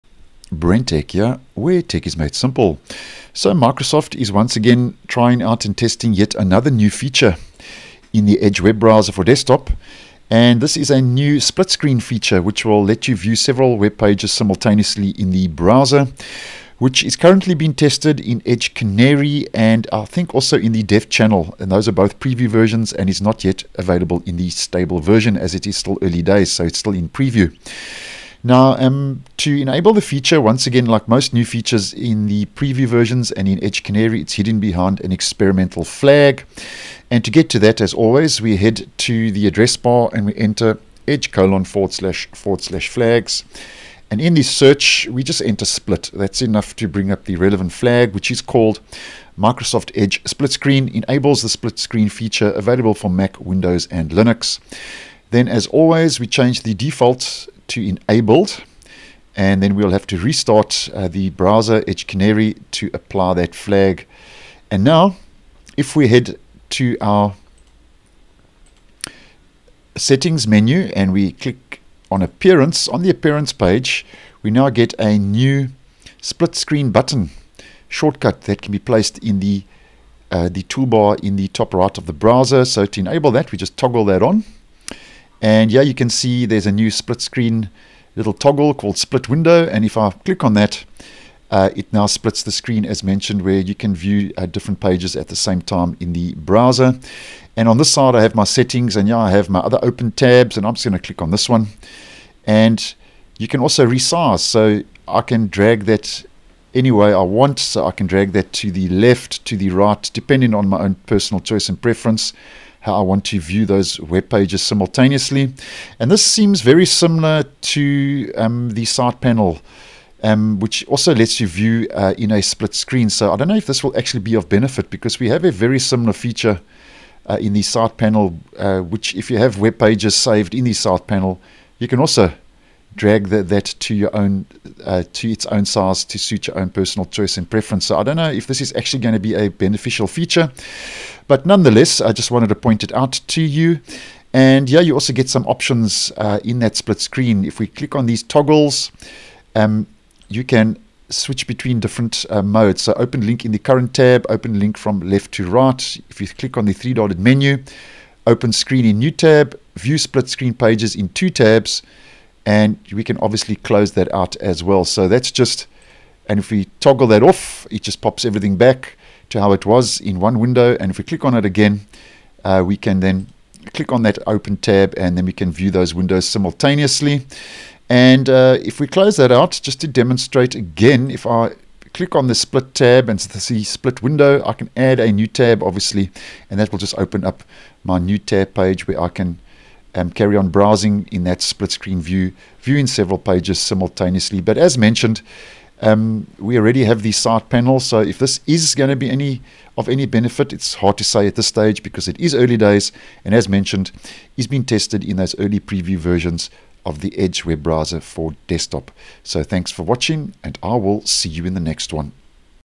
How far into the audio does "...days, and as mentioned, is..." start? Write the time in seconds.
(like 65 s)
202 s.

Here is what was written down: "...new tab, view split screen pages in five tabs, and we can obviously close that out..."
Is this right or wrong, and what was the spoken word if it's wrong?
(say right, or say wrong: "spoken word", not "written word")
wrong: "two", not "five".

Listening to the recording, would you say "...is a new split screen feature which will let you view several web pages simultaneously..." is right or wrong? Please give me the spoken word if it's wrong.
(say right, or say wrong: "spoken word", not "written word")
right.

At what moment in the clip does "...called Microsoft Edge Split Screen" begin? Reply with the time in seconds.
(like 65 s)
48 s.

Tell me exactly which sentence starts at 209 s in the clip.
So thanks for watching, and I will see you in the next one.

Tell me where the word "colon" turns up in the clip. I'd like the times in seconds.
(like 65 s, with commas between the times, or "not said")
41 s.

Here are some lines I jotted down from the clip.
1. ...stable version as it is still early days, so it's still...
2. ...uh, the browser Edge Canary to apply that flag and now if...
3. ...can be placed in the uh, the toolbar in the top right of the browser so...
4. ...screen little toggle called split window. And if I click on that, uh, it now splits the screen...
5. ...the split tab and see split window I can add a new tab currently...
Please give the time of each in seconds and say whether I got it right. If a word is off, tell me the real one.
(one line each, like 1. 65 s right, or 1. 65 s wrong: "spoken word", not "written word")
1. 24 s right
2. 60 s right
3. 78 s right
4. 87 s right
5. 182 s wrong: "obviously", not "currently".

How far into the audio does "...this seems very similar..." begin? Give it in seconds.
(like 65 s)
116 s.